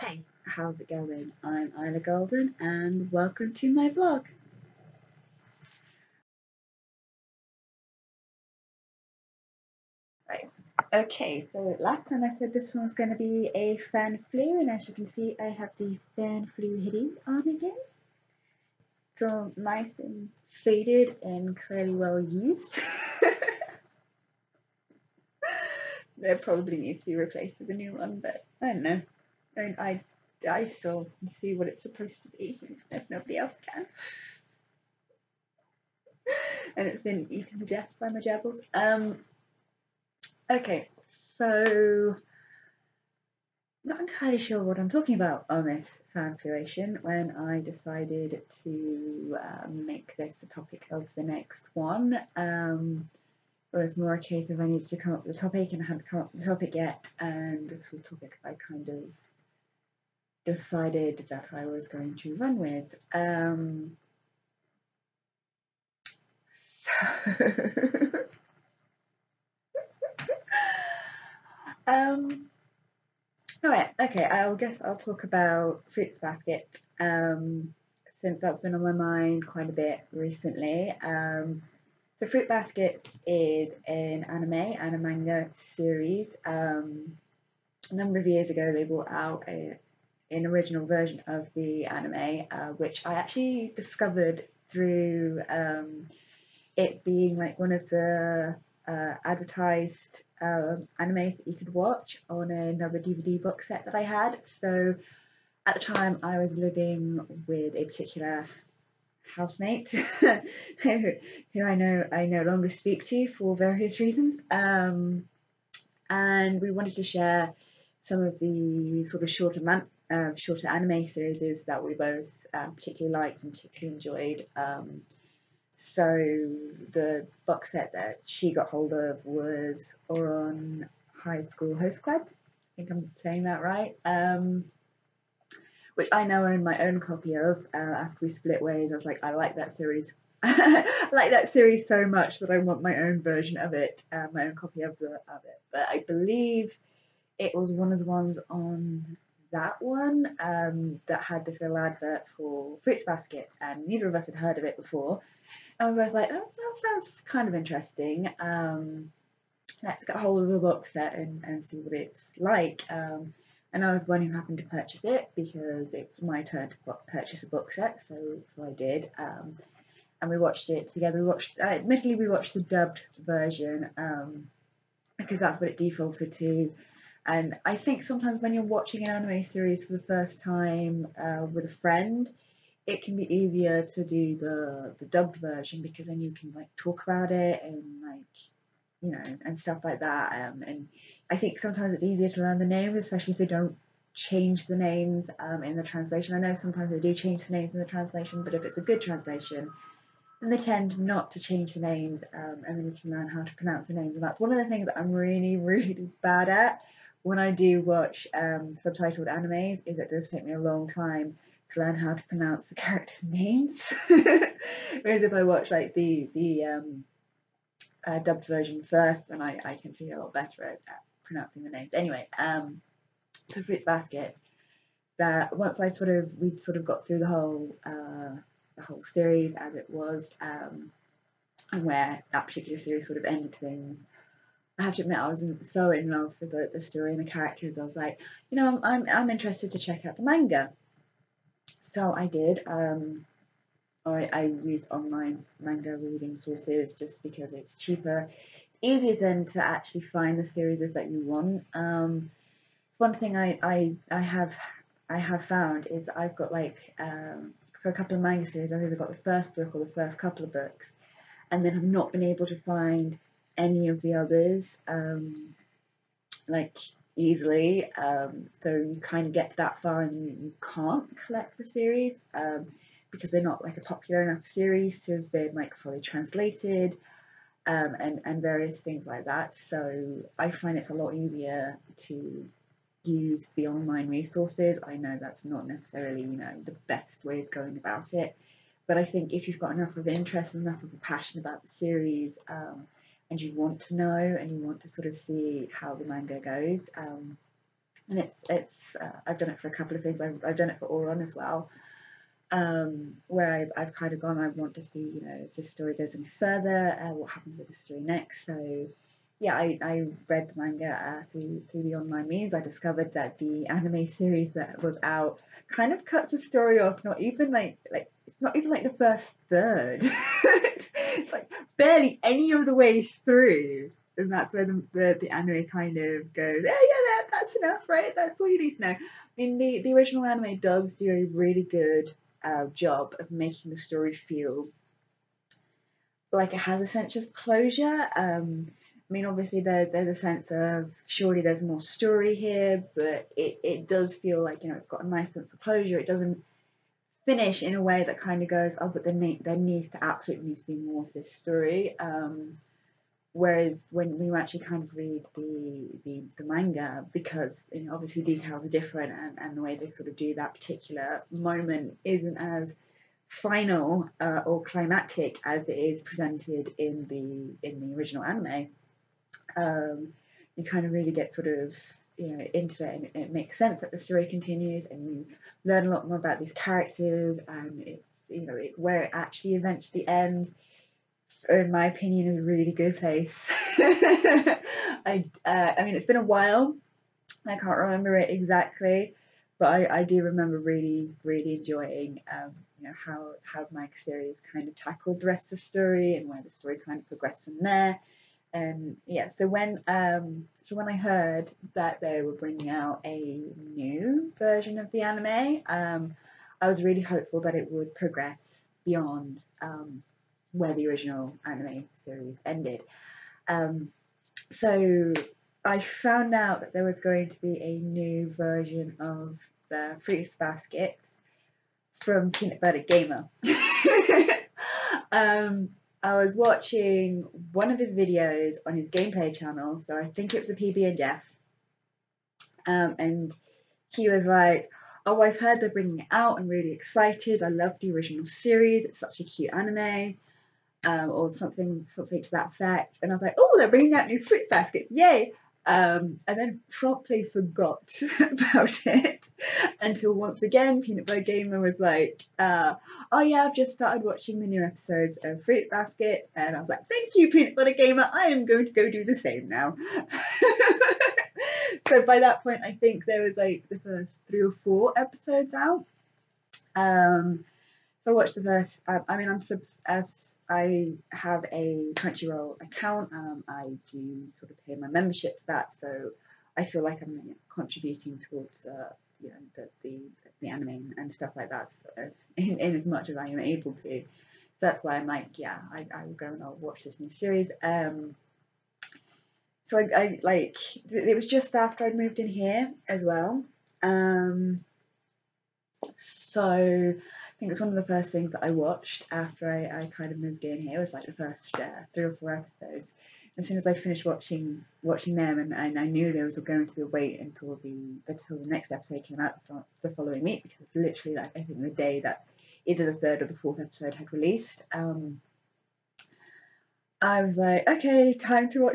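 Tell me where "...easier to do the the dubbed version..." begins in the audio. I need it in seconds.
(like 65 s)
183 s.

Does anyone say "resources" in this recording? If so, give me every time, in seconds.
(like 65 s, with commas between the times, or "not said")
284 s.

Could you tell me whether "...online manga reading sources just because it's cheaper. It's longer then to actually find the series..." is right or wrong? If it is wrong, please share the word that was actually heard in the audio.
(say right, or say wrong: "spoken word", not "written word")
wrong: "easier", not "longer".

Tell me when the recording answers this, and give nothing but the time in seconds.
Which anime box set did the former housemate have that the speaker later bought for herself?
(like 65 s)
130 s.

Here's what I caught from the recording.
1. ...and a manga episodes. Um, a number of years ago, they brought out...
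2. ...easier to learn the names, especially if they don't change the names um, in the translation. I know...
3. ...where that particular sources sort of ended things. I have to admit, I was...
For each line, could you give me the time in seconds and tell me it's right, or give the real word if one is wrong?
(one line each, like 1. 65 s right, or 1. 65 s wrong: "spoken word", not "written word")
1. 84 s wrong: "series", not "episodes"
2. 192 s right
3. 231 s wrong: "series", not "sources".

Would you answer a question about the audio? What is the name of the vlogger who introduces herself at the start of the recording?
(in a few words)
Ila Golden.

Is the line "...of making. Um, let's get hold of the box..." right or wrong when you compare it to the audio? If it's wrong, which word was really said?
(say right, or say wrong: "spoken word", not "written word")
wrong: "interesting", not "making".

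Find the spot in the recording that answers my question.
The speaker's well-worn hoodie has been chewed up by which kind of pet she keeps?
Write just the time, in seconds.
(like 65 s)
38 s.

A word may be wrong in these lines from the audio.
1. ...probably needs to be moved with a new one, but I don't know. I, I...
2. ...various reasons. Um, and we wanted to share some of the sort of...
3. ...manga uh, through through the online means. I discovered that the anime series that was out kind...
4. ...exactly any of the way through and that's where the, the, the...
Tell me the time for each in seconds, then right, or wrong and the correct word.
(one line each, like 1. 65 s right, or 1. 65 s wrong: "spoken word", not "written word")
1. 26 s wrong: "replaced", not "moved"
2. 113 s right
3. 310 s right
4. 321 s wrong: "barely", not "exactly".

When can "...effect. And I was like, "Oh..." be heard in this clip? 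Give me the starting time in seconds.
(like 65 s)
442 s.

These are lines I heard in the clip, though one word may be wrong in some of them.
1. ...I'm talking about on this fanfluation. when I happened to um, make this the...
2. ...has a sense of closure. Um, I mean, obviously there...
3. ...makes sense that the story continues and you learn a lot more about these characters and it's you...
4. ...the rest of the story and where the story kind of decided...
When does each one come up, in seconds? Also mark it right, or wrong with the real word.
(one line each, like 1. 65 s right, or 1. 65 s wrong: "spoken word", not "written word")
1. 44 s wrong: "decided", not "happened"
2. 336 s right
3. 373 s right
4. 395 s wrong: "progressed", not "decided".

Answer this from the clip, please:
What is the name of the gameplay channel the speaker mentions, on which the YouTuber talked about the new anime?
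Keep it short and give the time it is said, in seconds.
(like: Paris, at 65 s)
PB and Jeff, at 430 s.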